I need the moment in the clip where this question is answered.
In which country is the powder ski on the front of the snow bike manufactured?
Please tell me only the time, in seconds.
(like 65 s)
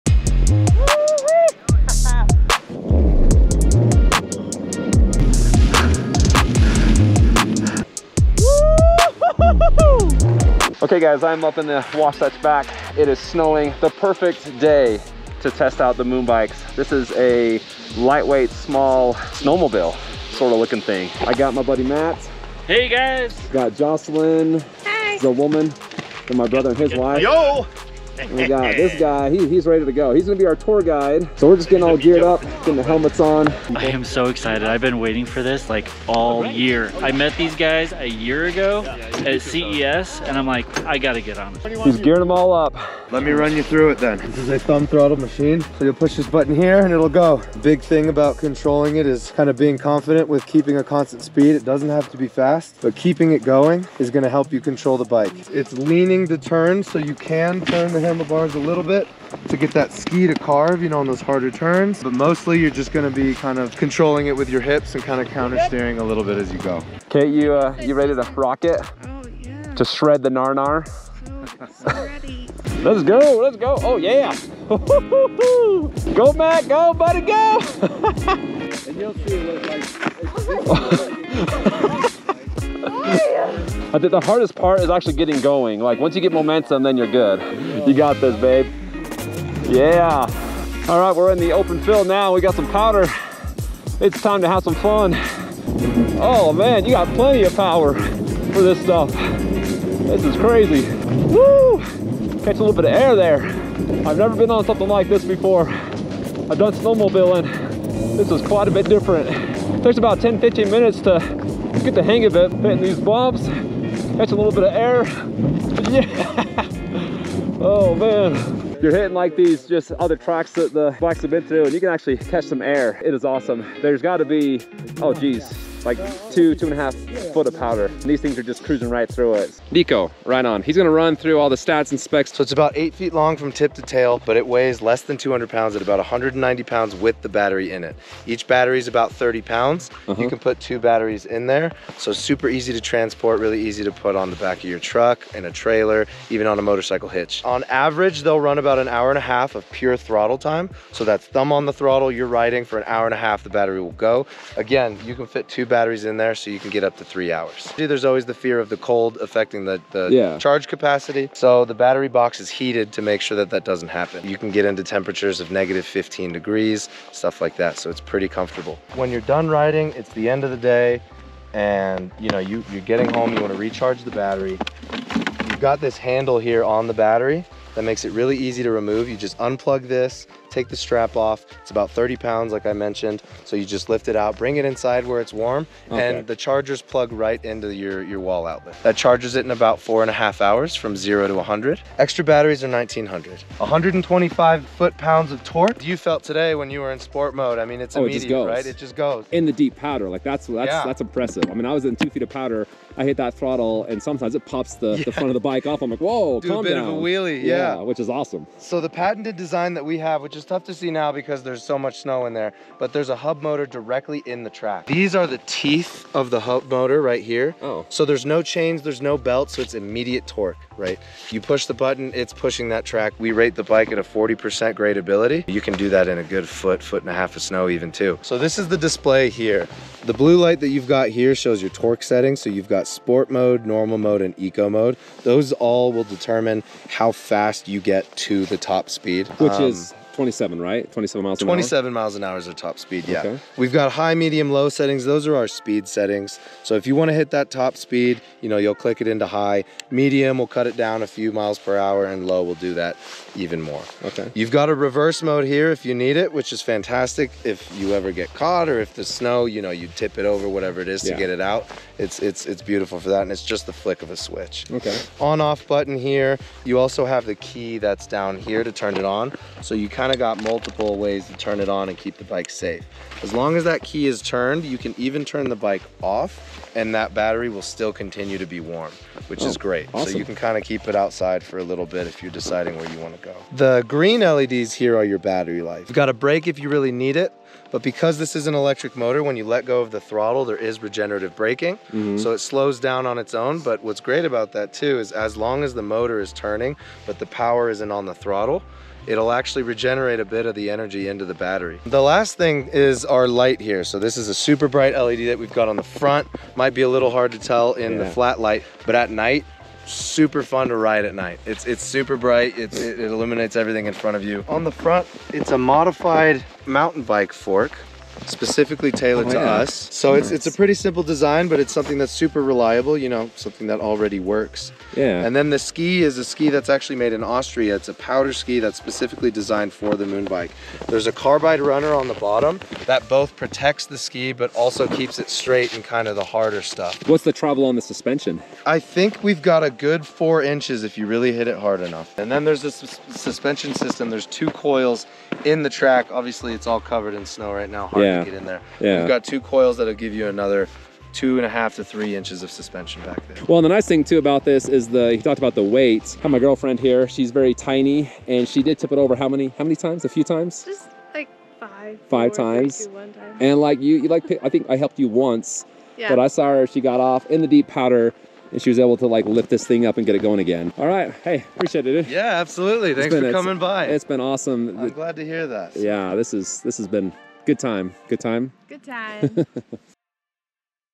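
327 s.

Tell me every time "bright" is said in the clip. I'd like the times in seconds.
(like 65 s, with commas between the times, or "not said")
304 s, 312 s.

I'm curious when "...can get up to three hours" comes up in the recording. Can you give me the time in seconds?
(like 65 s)
156 s.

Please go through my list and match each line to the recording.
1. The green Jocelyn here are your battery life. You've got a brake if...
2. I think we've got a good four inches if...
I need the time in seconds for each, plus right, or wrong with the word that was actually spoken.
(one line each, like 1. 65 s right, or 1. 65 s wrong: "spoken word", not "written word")
1. 283 s wrong: "LEDs", not "Jocelyn"
2. 338 s right.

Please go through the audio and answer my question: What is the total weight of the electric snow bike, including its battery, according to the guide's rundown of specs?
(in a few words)
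190 pounds.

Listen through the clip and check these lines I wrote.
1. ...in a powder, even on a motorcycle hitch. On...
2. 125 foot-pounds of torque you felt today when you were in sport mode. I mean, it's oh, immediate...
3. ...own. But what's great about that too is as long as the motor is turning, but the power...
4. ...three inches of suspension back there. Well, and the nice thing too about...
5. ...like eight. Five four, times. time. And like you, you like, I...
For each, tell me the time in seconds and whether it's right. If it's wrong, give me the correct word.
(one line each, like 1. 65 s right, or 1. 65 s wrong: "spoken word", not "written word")
1. 145 s wrong: "trailer", not "powder"
2. 193 s right
3. 293 s right
4. 351 s right
5. 361 s wrong: "five", not "eight".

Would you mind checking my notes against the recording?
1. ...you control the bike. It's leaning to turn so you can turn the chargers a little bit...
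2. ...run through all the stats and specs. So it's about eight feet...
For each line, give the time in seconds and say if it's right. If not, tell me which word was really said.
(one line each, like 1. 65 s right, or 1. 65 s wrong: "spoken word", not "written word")
1. 54 s wrong: "handlebars", not "chargers"
2. 130 s right.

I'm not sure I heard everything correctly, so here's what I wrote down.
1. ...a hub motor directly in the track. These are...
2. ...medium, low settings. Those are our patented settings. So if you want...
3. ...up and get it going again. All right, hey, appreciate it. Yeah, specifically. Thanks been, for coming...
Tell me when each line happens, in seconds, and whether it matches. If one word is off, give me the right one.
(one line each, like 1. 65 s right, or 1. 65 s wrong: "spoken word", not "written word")
1. 213 s right
2. 244 s wrong: "speed", not "patented"
3. 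369 s wrong: "absolutely", not "specifically".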